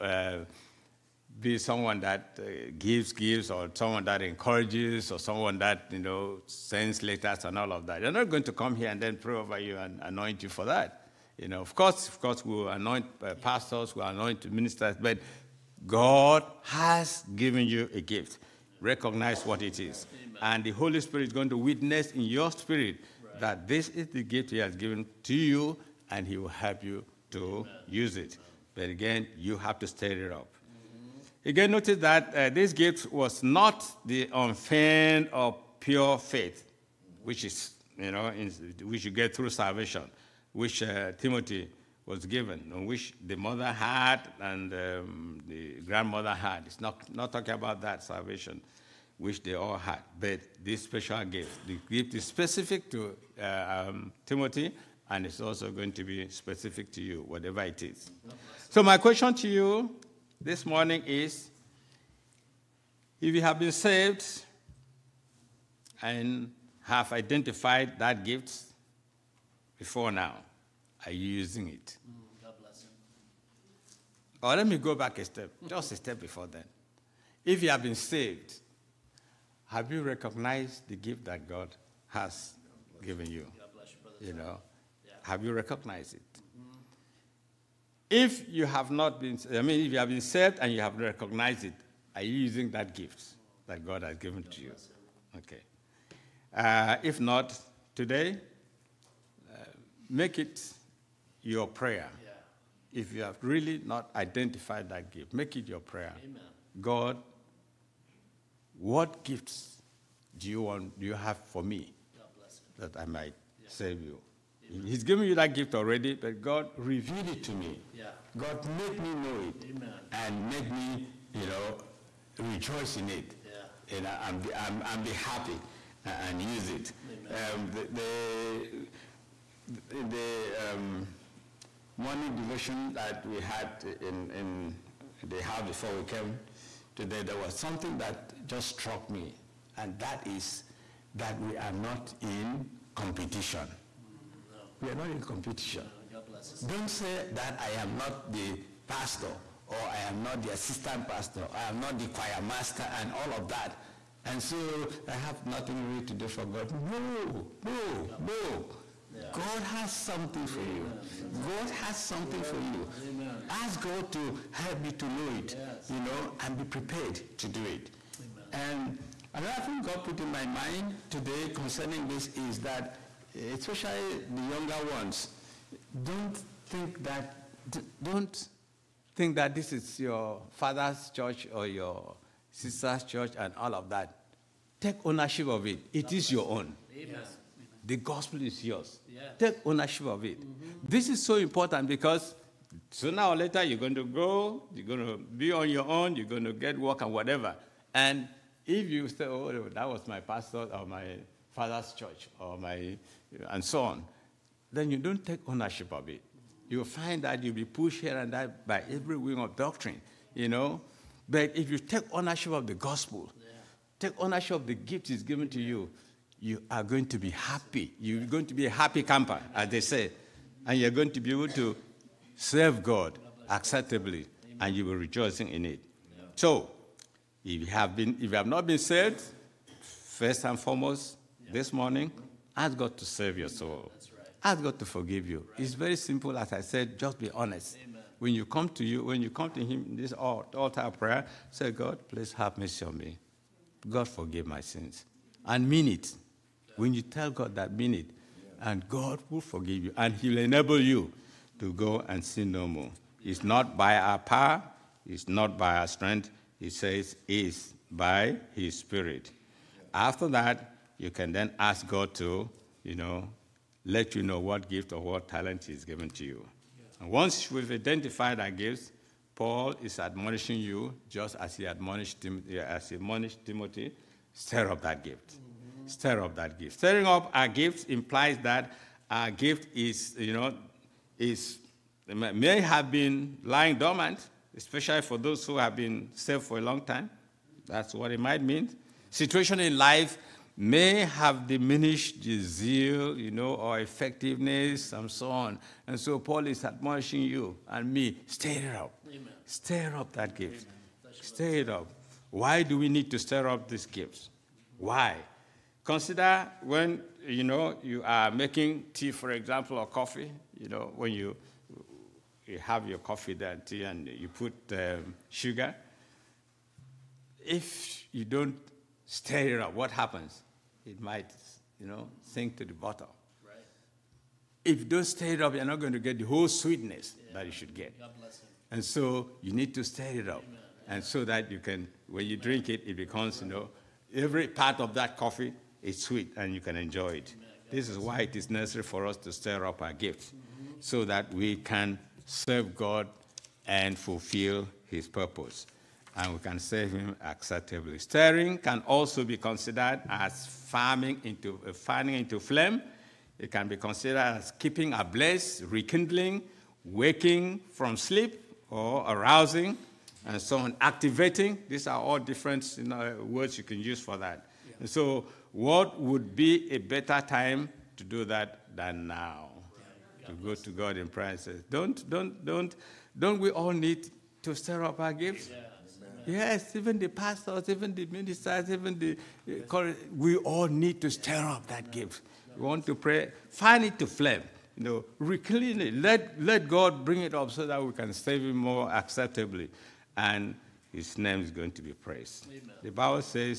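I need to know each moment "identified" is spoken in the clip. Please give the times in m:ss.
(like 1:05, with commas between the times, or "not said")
1:07, 1:44, 4:27.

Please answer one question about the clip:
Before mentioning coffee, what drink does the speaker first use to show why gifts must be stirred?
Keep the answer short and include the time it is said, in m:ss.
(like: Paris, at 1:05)
Making tea, at 5:08.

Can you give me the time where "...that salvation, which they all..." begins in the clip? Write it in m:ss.
0:47.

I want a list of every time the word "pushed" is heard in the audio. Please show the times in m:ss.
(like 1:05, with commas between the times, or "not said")
3:27.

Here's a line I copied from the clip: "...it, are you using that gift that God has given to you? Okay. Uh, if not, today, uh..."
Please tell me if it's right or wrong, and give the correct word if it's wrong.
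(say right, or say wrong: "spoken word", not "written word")
right.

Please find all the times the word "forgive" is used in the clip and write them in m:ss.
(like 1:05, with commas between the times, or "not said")
3:54, 4:04, 4:09.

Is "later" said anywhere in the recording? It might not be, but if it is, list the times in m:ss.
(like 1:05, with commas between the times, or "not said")
3:13.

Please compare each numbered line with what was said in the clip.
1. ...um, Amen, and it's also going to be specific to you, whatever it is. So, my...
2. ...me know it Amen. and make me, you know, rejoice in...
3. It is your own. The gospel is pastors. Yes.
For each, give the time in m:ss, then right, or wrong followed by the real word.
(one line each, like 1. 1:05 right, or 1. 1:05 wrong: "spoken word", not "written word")
1. 0:53 wrong: "Timothy", not "Amen"
2. 1:58 right
3. 3:05 wrong: "yours", not "pastors".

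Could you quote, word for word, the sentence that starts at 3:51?
this morning, ask God to save your soul.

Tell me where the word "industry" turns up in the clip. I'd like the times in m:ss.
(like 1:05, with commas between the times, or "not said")
not said.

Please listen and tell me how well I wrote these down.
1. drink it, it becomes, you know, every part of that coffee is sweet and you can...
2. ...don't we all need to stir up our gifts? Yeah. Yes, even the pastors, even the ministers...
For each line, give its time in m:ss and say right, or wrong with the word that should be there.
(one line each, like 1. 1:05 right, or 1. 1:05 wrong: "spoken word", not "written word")
1. 5:32 right
2. 6:13 right.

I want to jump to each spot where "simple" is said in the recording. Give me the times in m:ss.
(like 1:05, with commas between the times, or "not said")
3:55.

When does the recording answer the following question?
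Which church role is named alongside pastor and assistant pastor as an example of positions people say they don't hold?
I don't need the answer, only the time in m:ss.
2:32.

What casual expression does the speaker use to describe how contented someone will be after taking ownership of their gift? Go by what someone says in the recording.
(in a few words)
Happy camper.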